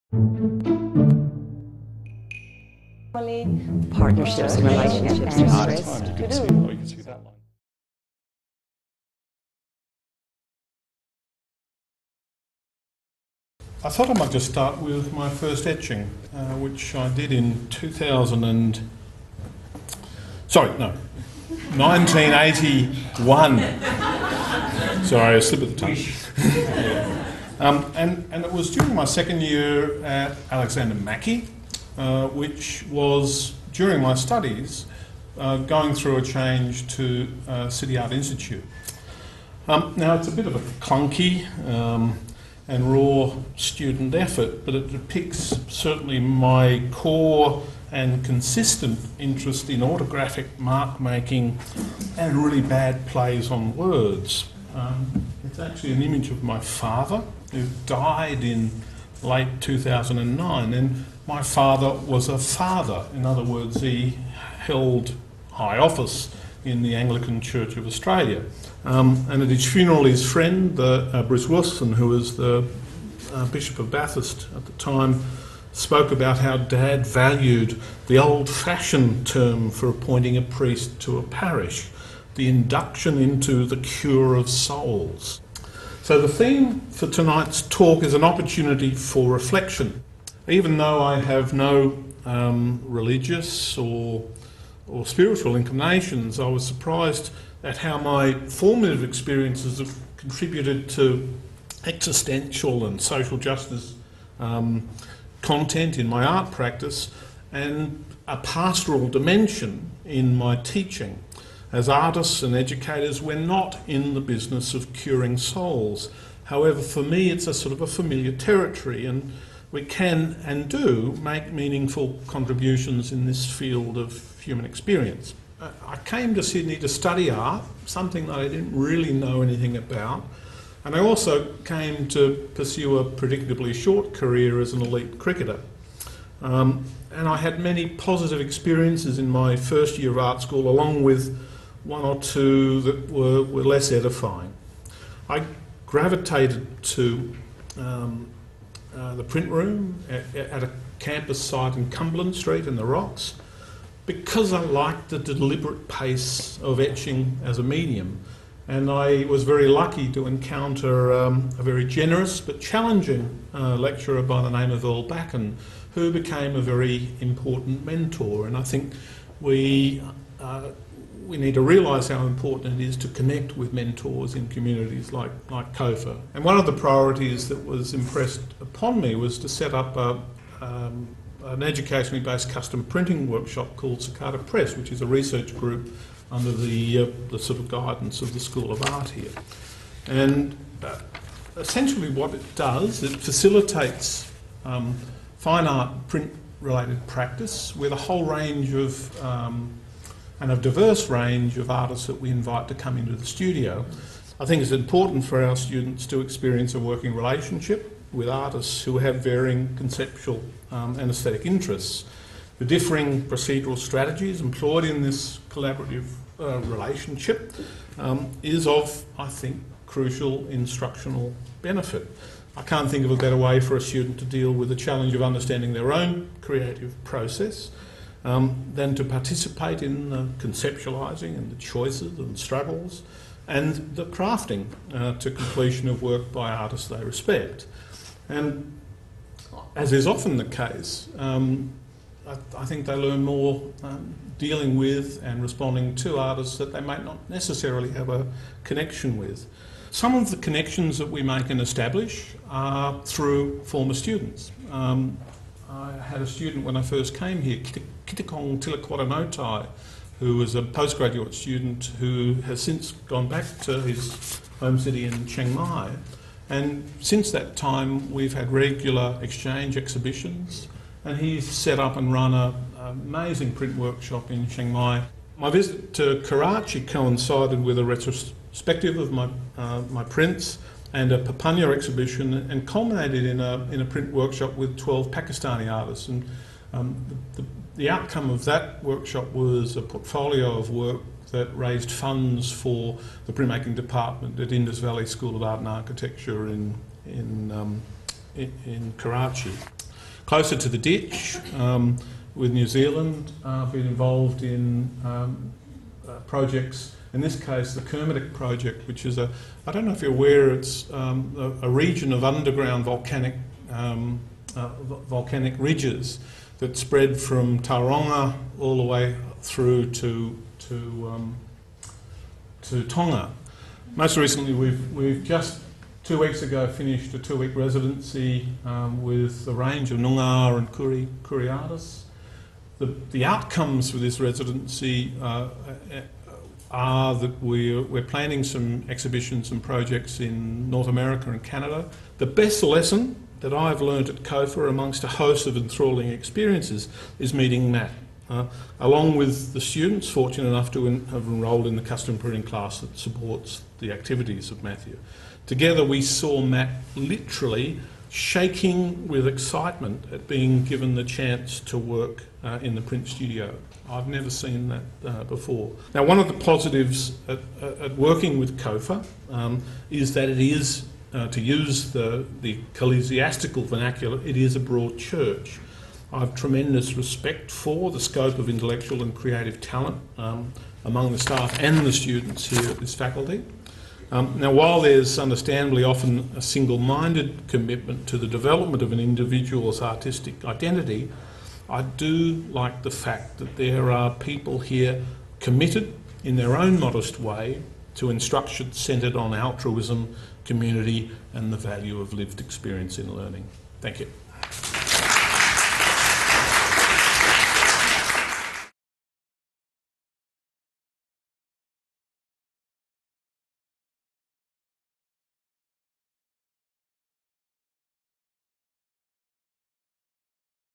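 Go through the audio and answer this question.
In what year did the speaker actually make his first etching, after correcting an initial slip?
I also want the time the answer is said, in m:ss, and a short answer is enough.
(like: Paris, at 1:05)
1981, at 0:21.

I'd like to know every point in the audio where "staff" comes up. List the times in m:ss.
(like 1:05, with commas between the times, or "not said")
6:21.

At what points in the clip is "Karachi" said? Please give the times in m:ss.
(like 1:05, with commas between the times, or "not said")
4:36, 4:58.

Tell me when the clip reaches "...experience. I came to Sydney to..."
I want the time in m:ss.
2:04.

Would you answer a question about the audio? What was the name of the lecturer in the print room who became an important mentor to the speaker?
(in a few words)
Earl Backen.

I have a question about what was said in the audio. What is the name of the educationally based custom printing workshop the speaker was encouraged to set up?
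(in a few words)
Cicada Press.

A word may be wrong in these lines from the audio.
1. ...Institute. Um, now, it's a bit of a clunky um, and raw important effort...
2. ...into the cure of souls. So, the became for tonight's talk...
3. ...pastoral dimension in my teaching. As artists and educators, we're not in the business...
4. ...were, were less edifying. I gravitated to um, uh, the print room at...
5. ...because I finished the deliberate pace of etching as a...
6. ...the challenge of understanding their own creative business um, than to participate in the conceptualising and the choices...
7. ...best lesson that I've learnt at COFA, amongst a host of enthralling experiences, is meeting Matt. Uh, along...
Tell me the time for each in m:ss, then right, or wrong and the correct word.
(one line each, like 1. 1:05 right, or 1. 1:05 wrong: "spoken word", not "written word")
1. 0:38 wrong: "student", not "important"
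2. 1:23 wrong: "theme", not "became"
3. 1:48 right
4. 2:23 right
5. 2:34 wrong: "liked", not "finished"
6. 3:44 wrong: "process", not "business"
7. 5:42 right.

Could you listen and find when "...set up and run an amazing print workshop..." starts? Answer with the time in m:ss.
4:31.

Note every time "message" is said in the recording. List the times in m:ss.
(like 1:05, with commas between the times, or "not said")
not said.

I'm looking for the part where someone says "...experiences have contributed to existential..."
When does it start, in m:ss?
1:39.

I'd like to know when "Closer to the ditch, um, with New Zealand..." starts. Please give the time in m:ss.
5:00.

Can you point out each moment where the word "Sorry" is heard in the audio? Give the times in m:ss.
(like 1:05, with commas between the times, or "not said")
0:20, 0:25.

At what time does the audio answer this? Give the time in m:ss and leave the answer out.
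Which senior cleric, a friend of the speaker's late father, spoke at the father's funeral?
1:11.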